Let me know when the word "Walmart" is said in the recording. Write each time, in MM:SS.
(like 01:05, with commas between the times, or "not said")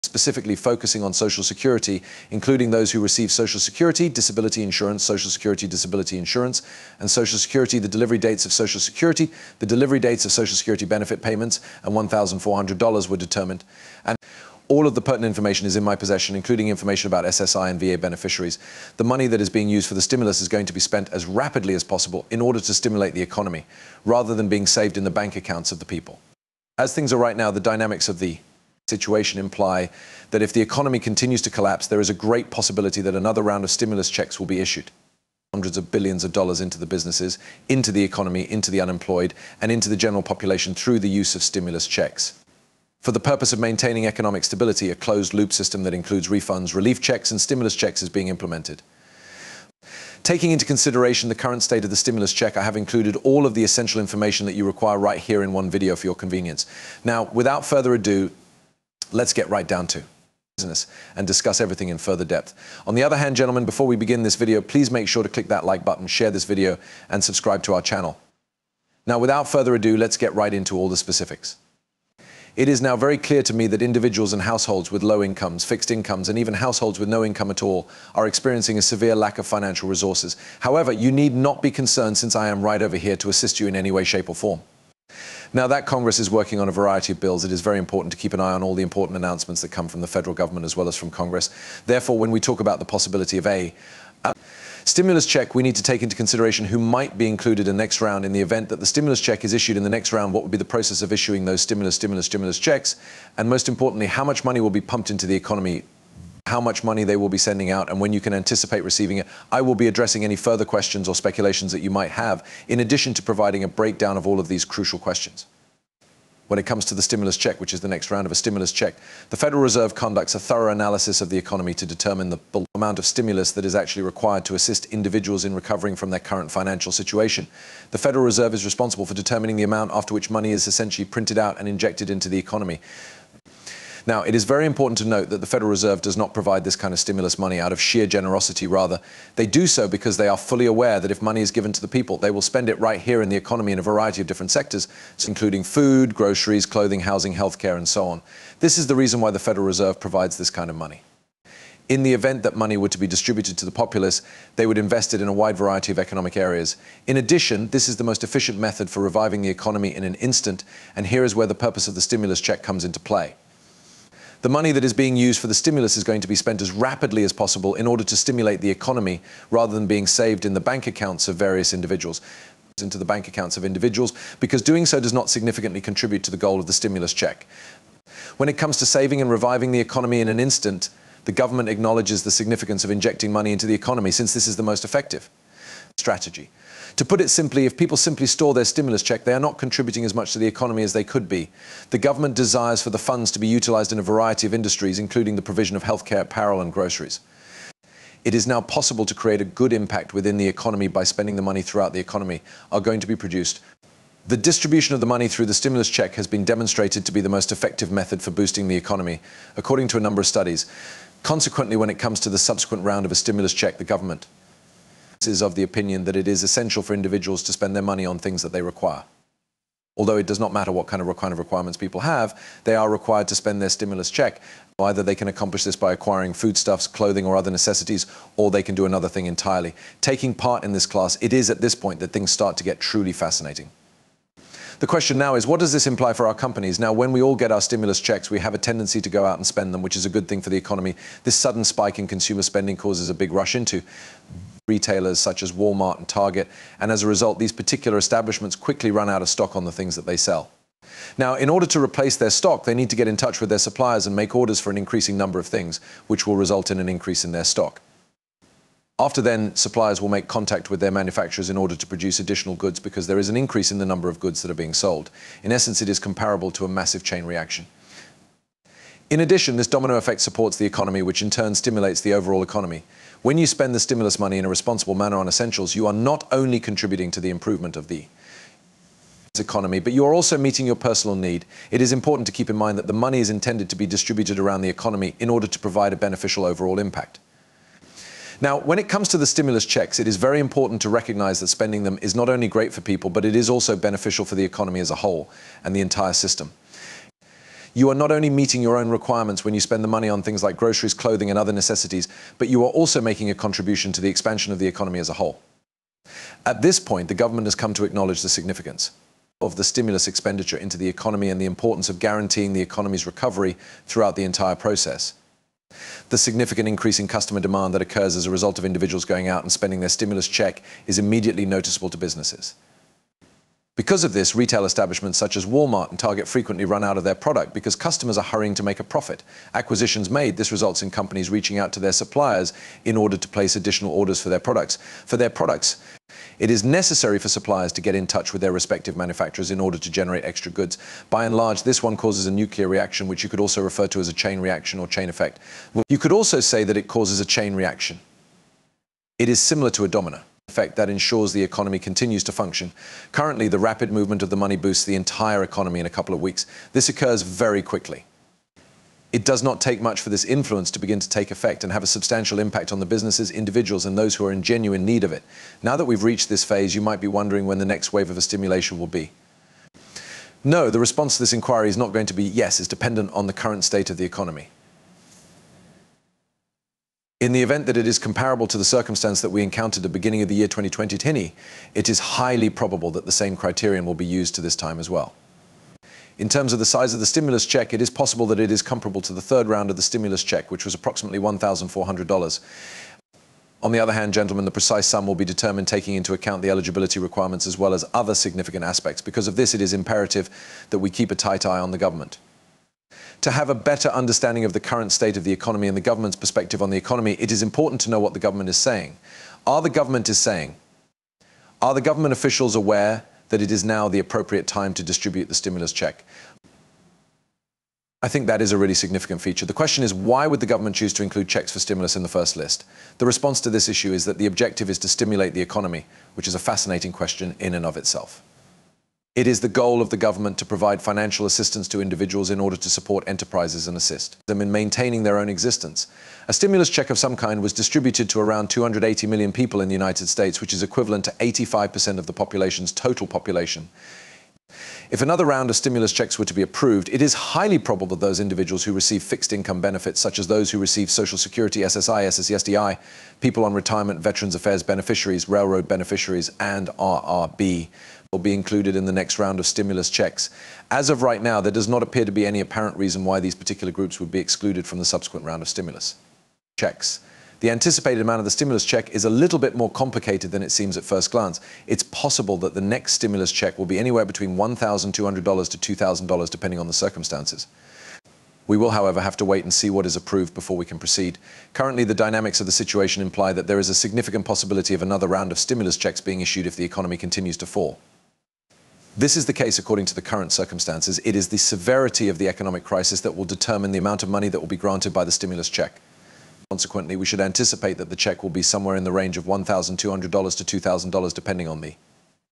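04:05, 05:25.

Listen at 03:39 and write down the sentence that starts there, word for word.
Although it does not matter what kind of, kind of requirements people have, they are required to spend their stimulus check.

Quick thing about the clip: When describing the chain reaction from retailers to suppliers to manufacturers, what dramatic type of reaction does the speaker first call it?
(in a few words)
nuclear reaction.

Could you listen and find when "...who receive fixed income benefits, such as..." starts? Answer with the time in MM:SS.
07:28.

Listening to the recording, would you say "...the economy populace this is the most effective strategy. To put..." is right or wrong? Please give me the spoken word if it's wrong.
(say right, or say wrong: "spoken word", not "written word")
wrong: "since", not "populace".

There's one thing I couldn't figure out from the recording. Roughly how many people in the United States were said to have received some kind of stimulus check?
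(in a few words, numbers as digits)
280 million.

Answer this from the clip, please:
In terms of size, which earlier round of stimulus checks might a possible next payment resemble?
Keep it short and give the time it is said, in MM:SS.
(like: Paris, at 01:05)
third round, at 06:29.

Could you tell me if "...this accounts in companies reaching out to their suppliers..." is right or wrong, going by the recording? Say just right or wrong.
wrong.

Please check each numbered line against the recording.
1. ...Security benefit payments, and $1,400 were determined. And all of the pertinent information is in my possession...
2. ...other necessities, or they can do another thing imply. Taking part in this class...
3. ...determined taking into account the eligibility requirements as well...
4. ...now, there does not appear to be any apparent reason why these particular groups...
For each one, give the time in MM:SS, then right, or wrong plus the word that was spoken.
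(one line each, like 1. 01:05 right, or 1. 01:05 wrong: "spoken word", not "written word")
1. 00:10 right
2. 03:47 wrong: "entirely", not "imply"
3. 06:35 right
4. 07:41 right.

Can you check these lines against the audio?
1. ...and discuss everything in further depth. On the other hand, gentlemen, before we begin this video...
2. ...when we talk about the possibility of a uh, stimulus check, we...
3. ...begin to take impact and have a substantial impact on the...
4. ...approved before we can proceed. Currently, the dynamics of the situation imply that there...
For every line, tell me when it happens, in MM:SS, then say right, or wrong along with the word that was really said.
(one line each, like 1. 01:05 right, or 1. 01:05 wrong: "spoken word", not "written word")
1. 01:01 right
2. 01:32 right
3. 06:00 wrong: "effect", not "impact"
4. 07:59 right.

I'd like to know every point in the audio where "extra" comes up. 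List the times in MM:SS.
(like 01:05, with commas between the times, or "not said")
05:40.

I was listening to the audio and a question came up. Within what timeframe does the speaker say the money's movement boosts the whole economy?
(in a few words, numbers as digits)
a couple of weeks.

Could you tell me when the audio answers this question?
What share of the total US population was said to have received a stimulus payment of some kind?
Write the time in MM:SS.
07:21.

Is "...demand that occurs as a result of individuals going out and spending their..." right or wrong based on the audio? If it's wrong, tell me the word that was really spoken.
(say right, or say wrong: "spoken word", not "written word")
right.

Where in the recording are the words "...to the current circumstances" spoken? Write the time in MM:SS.
08:09.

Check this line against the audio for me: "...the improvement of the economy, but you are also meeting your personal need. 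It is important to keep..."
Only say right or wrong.
right.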